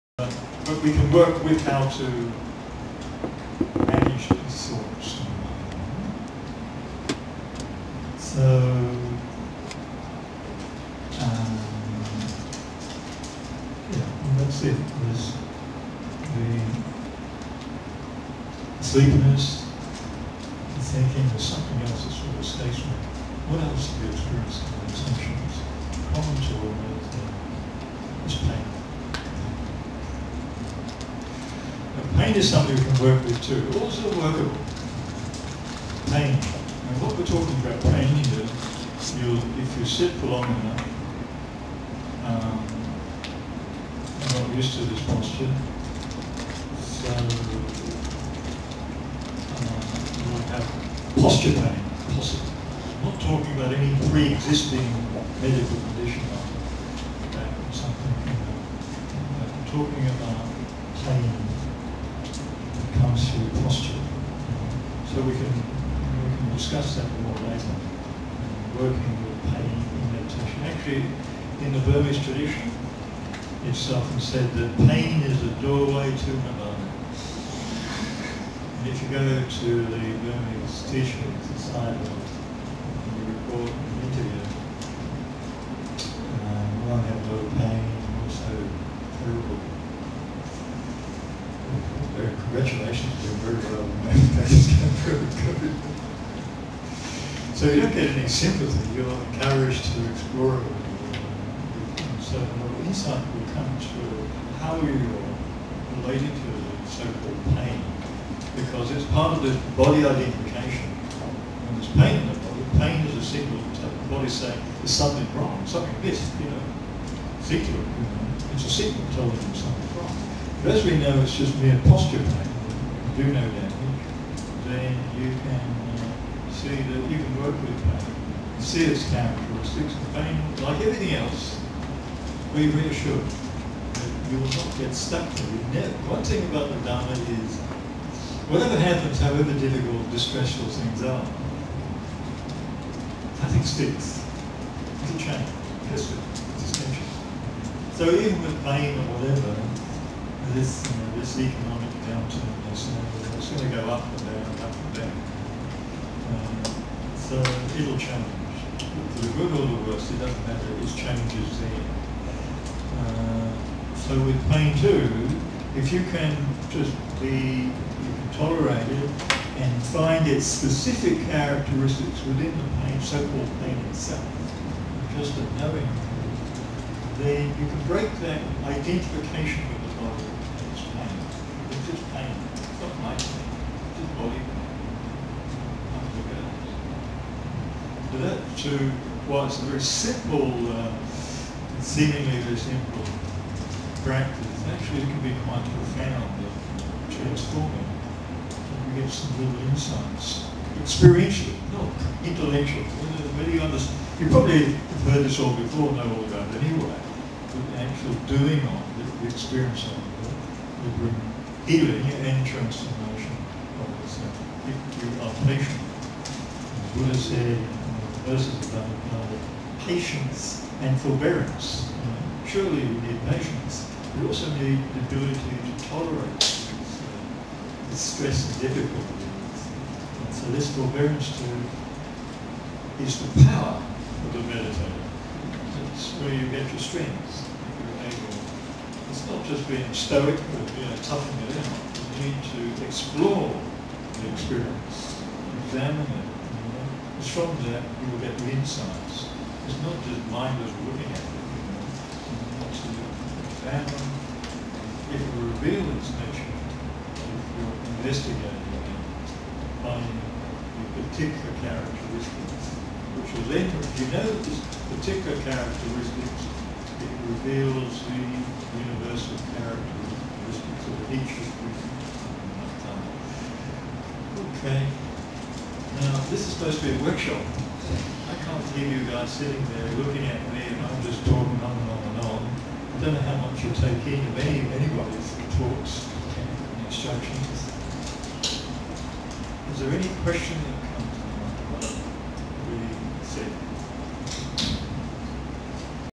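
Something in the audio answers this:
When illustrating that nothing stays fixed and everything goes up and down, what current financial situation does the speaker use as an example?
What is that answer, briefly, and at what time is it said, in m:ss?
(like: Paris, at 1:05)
economic downturn, at 2:31.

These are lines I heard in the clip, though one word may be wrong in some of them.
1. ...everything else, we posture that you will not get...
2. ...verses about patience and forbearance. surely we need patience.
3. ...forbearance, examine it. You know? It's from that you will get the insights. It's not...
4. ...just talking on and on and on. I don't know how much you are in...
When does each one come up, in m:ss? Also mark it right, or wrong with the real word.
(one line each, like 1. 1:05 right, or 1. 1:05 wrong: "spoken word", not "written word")
1. 2:10 wrong: "reassure", not "posture"
2. 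3:38 right
3. 4:04 wrong: "experience", not "forbearance"
4. 4:41 right.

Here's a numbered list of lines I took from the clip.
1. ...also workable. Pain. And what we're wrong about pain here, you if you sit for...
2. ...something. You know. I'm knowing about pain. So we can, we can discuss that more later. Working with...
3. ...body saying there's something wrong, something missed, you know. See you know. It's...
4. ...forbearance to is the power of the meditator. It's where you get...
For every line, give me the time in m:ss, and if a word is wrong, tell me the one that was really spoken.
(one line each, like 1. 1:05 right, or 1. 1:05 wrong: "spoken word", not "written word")
1. 0:33 wrong: "talking", not "wrong"
2. 0:57 wrong: "talking", not "knowing"
3. 1:54 right
4. 3:50 right.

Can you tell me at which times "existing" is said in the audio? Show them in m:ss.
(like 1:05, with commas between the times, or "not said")
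0:54.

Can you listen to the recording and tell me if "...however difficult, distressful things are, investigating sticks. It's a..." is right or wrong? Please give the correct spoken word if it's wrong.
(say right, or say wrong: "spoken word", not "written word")
wrong: "nothing", not "investigating".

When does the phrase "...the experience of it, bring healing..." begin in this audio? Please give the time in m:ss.
3:29.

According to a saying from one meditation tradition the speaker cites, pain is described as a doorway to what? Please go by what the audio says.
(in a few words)
nirvana.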